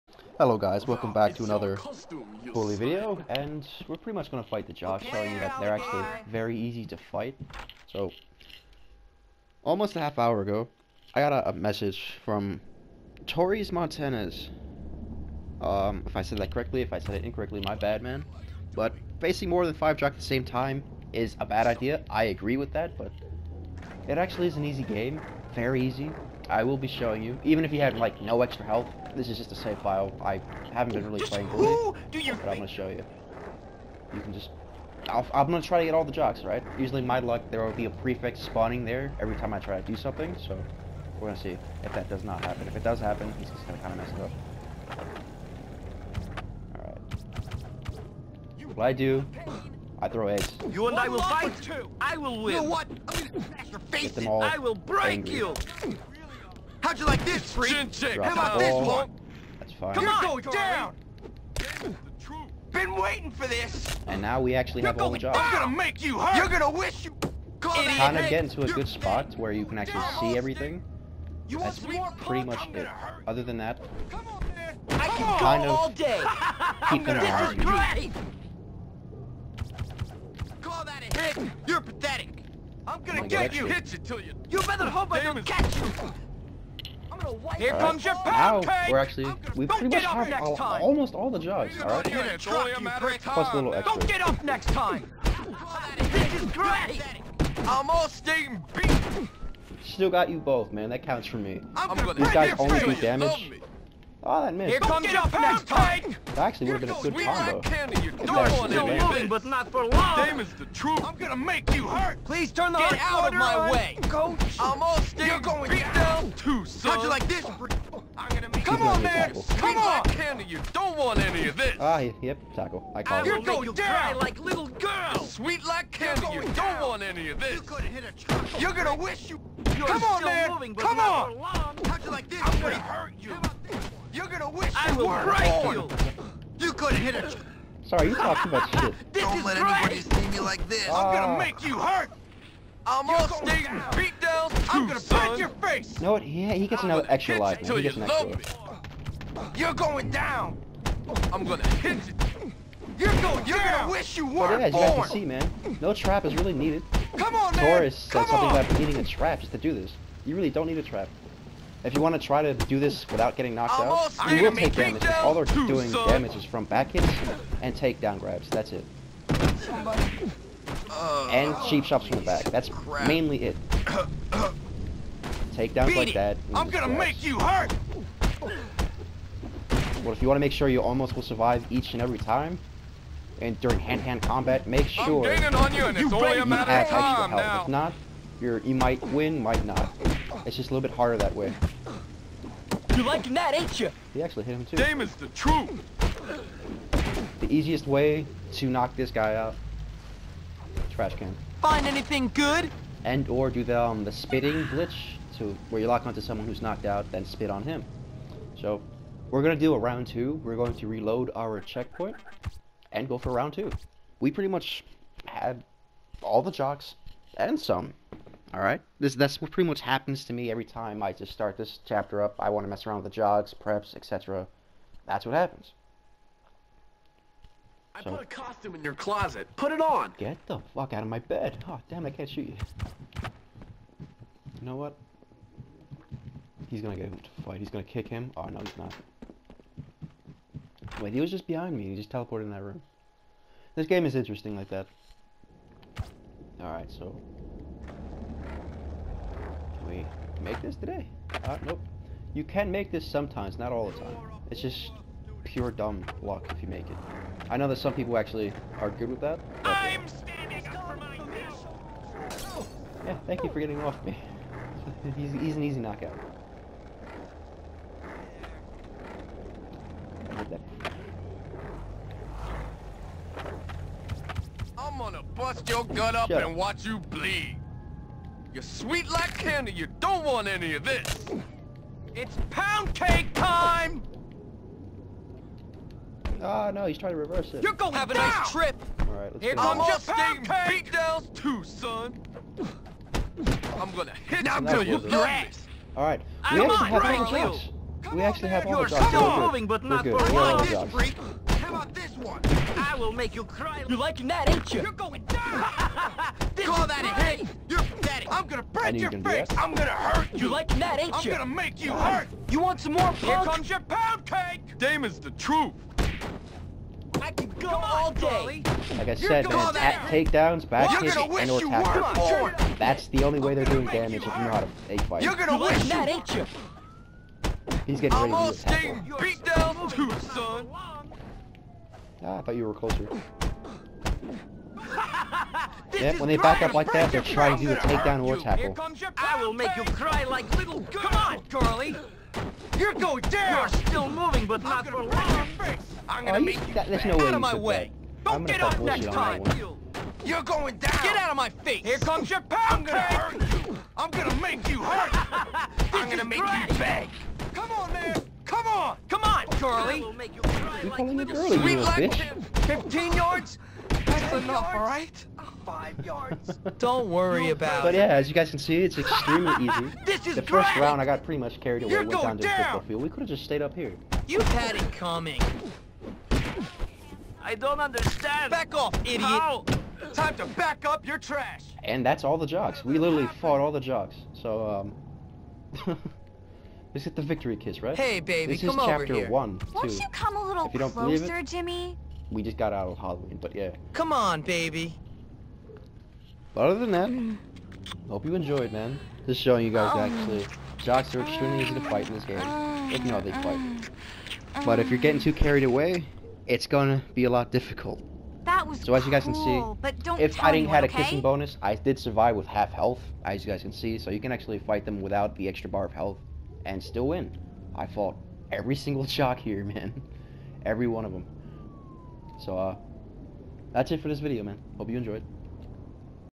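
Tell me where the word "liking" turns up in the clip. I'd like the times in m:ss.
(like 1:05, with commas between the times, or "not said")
3:13, 5:03.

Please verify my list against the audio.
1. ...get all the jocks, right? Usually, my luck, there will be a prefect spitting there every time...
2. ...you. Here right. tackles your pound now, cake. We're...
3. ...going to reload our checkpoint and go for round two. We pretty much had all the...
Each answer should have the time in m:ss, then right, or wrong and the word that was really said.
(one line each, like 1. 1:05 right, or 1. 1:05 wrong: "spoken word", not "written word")
1. 0:35 wrong: "spawning", not "spitting"
2. 1:25 wrong: "comes", not "tackles"
3. 3:30 right.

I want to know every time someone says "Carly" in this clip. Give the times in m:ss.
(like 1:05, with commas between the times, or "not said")
5:41, 5:59.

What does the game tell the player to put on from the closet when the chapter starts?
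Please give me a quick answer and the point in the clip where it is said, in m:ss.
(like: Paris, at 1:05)
a costume, at 3:48.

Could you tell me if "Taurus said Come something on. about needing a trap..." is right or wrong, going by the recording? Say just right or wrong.
right.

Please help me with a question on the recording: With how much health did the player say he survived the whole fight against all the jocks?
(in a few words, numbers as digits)
Half health.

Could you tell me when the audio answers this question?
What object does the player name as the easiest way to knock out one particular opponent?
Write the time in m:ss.
3:20.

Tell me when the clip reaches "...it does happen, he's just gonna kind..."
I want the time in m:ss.
0:42.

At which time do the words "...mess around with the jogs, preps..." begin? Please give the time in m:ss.
3:42.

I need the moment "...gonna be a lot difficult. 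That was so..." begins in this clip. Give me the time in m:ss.
6:46.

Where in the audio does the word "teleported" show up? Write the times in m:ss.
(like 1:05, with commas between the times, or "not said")
4:02.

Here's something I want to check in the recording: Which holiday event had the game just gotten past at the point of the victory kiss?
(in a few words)
Halloween.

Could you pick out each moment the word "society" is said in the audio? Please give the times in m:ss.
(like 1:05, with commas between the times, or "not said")
not said.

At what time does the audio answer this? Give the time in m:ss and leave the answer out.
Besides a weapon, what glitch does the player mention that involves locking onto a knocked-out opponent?
3:24.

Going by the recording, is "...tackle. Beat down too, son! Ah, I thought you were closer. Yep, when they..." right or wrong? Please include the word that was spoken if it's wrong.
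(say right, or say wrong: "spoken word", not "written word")
right.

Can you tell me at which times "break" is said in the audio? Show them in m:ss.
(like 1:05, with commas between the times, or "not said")
0:54, 2:15.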